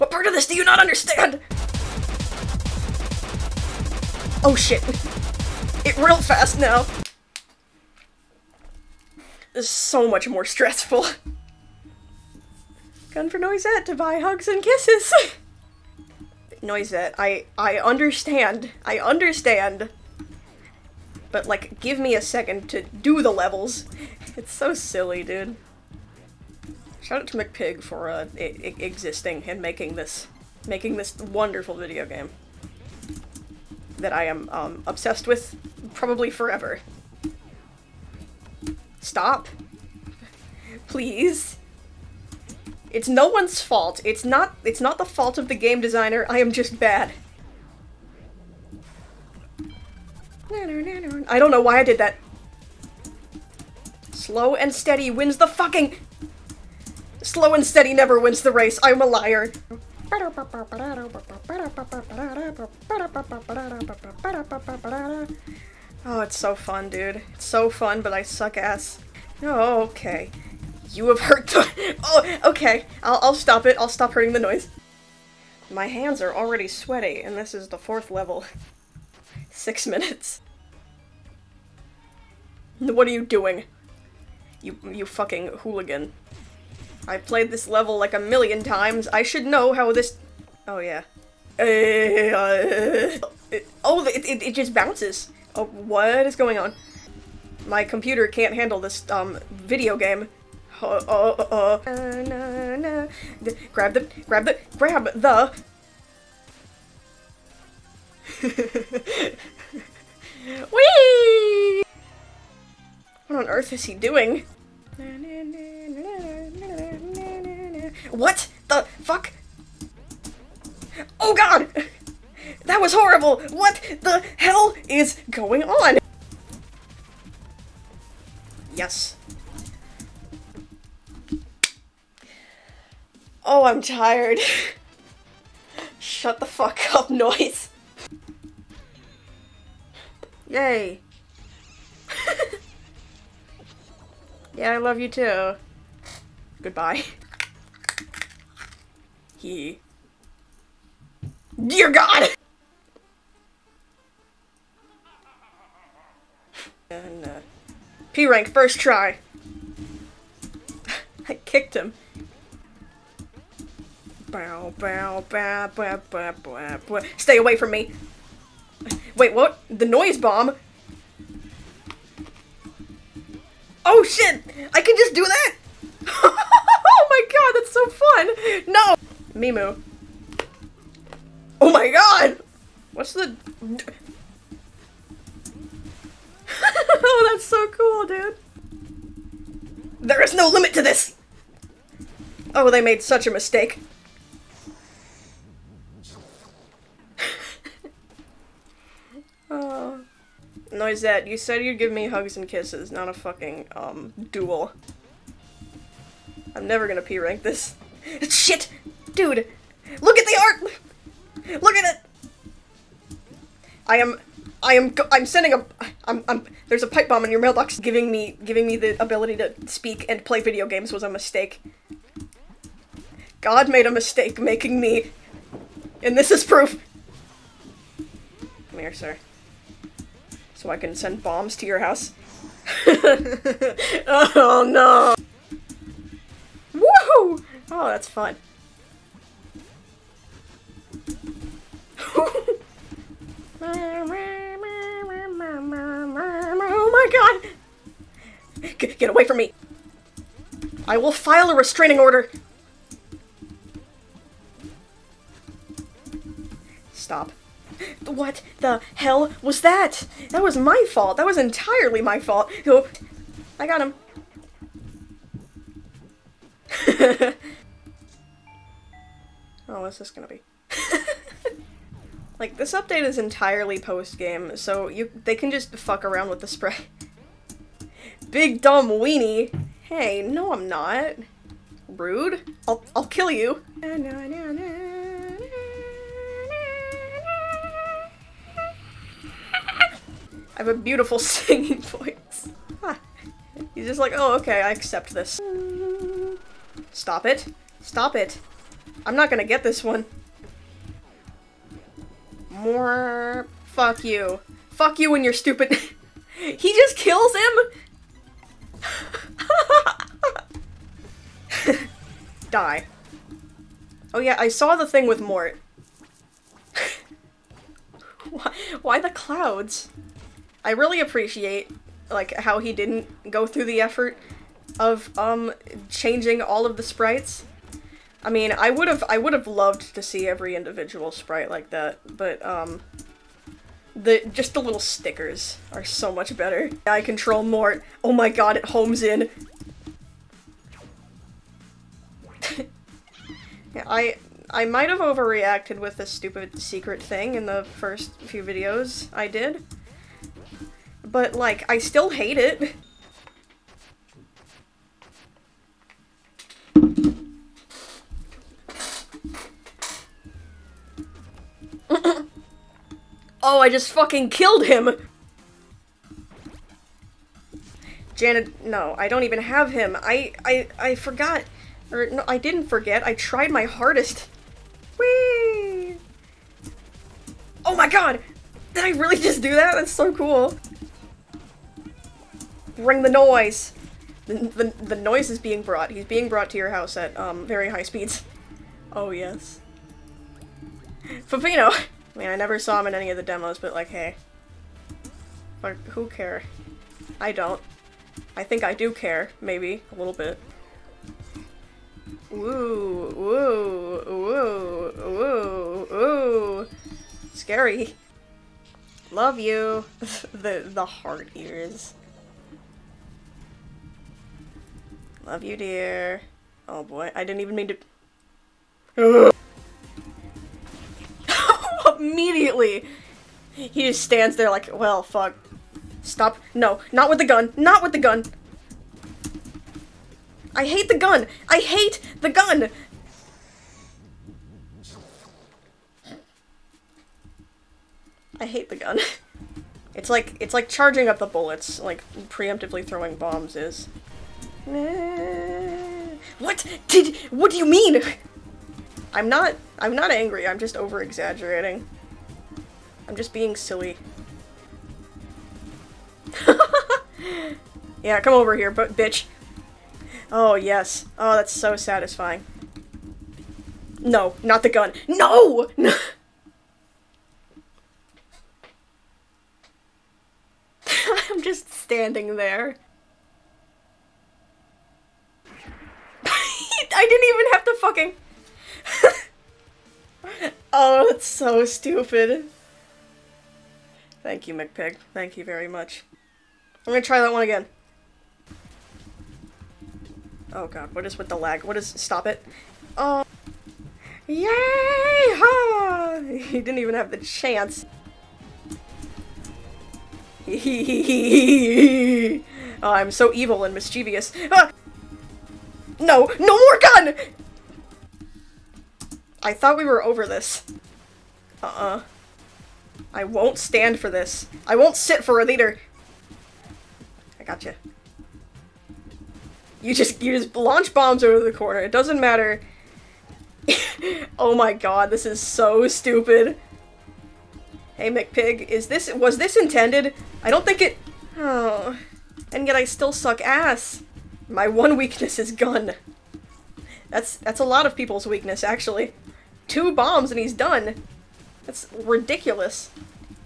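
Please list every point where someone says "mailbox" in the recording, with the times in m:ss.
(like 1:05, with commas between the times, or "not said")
3:37.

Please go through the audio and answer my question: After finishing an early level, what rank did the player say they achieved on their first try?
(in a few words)
P rank.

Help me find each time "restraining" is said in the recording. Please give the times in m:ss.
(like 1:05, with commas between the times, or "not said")
4:11.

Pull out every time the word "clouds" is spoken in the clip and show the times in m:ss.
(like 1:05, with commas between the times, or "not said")
5:19.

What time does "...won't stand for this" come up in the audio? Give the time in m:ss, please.
8:33.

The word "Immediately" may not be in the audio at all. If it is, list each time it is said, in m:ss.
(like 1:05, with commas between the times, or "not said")
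7:01.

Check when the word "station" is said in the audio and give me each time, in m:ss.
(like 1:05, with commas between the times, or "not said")
not said.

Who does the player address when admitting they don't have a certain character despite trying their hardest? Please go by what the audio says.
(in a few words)
Janet.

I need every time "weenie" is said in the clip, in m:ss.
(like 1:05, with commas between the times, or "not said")
4:38.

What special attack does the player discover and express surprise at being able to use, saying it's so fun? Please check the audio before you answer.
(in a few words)
The noise bomb.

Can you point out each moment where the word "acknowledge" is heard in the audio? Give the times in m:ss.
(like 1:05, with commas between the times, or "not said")
not said.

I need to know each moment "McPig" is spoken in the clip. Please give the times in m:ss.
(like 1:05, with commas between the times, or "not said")
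0:27, 8:04, 8:48.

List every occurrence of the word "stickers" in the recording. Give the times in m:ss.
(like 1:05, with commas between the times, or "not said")
5:34.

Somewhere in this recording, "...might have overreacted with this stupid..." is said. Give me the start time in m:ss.
5:44.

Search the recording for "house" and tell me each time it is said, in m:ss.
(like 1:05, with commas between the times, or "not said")
3:51, 6:26.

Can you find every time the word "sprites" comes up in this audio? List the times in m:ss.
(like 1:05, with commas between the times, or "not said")
5:26, 5:31.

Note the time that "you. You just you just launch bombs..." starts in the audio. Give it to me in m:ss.
8:37.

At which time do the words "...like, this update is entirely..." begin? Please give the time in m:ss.
4:32.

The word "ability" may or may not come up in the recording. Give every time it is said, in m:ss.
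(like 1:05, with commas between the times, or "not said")
3:39.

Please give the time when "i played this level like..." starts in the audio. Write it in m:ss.
1:27.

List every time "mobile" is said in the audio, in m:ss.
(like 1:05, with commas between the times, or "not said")
not said.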